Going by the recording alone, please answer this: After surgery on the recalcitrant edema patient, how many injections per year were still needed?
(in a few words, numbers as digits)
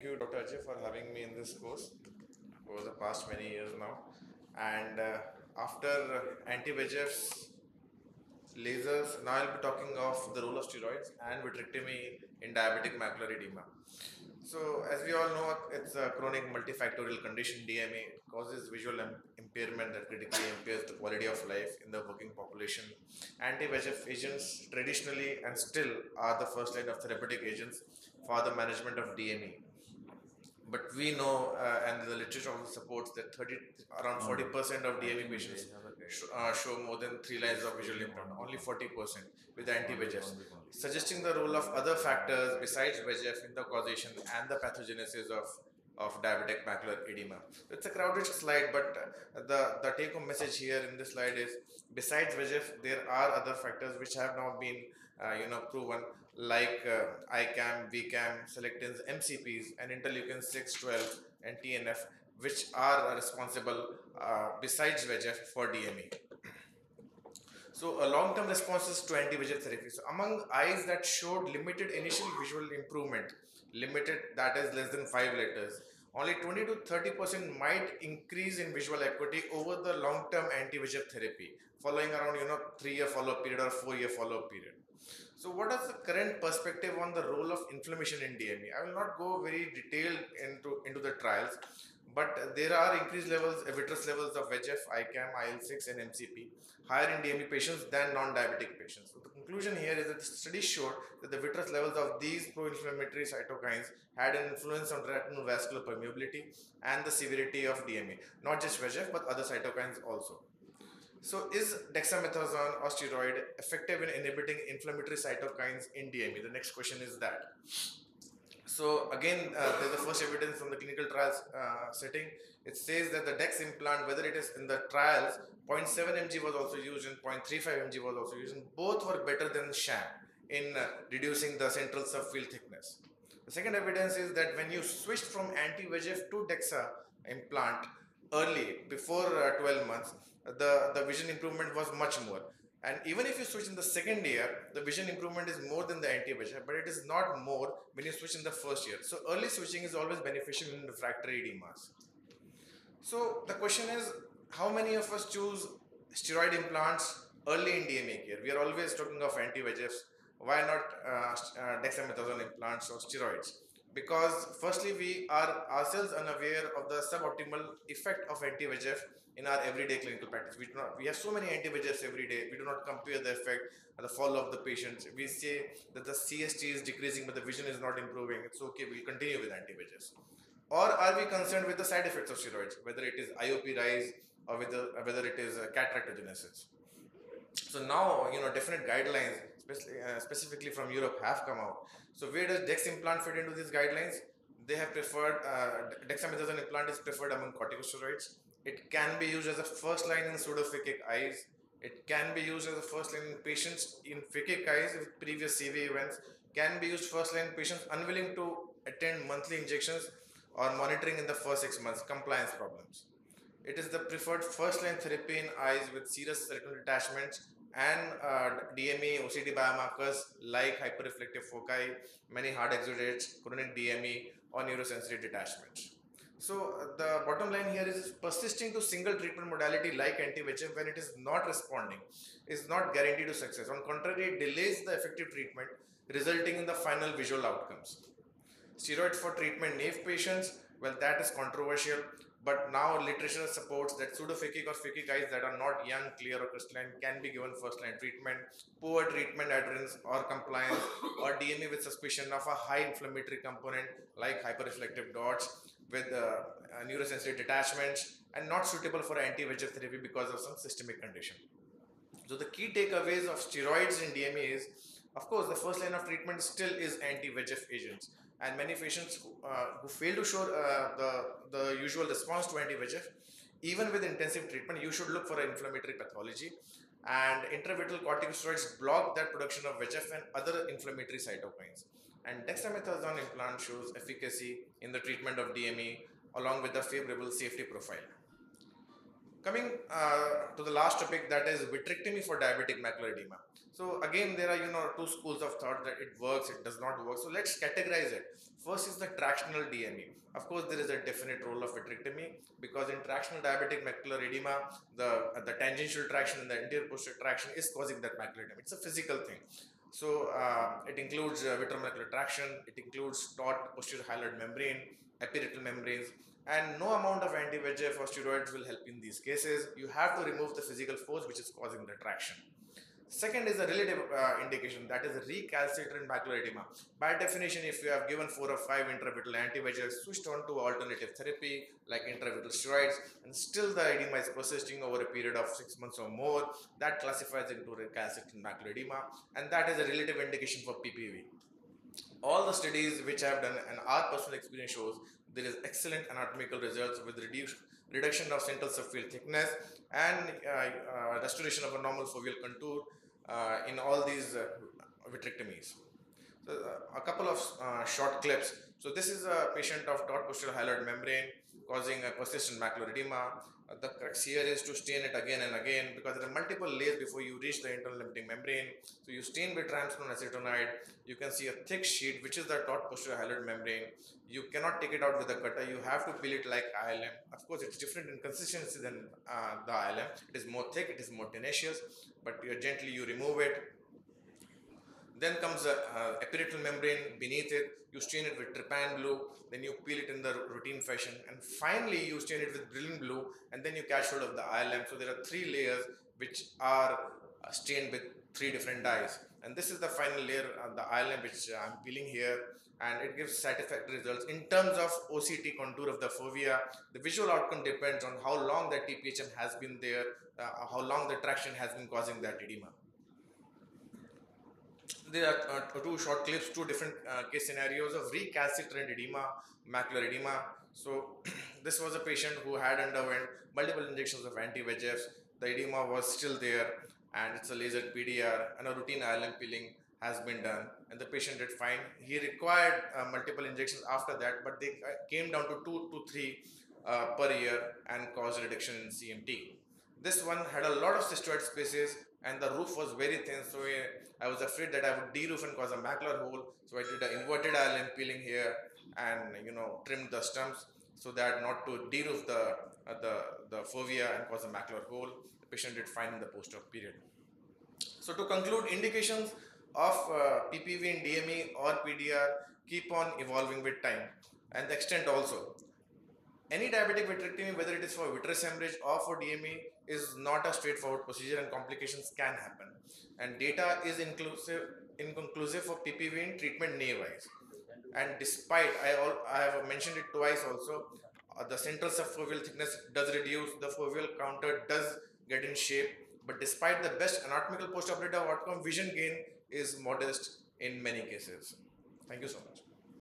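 2 to 3.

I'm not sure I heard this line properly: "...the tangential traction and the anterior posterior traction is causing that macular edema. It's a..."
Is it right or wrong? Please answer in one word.
right.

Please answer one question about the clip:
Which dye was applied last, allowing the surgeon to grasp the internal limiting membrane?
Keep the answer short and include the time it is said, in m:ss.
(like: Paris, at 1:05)
brilliant blue, at 6:32.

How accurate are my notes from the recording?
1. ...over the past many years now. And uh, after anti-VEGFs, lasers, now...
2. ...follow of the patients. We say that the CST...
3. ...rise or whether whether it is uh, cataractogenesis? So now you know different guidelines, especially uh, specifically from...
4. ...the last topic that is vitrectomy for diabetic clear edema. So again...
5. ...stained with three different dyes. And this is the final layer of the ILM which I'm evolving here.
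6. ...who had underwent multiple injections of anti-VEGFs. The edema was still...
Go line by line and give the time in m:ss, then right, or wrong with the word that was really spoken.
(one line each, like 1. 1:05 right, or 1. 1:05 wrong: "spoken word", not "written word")
1. 0:02 right
2. 2:54 right
3. 3:03 right
4. 4:50 wrong: "macular", not "clear"
5. 6:37 wrong: "peeling", not "evolving"
6. 7:02 right.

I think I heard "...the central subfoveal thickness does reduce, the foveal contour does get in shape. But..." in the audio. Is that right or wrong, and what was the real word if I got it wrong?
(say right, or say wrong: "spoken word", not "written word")
right.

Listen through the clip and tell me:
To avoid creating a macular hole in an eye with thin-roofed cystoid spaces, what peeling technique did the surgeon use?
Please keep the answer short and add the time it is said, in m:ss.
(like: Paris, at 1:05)
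inverted ILM peeling, at 7:27.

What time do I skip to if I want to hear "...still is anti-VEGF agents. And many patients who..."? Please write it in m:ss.
4:26.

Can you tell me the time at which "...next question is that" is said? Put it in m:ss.
1:56.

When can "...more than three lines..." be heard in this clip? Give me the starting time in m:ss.
0:36.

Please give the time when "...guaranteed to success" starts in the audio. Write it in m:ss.
3:52.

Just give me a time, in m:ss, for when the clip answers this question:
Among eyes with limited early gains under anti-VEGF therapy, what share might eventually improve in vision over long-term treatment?
1:16.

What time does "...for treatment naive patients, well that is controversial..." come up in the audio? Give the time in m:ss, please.
3:59.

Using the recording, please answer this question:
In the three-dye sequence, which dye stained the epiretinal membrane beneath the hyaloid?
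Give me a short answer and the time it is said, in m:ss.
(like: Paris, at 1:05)
trypan blue, at 6:28.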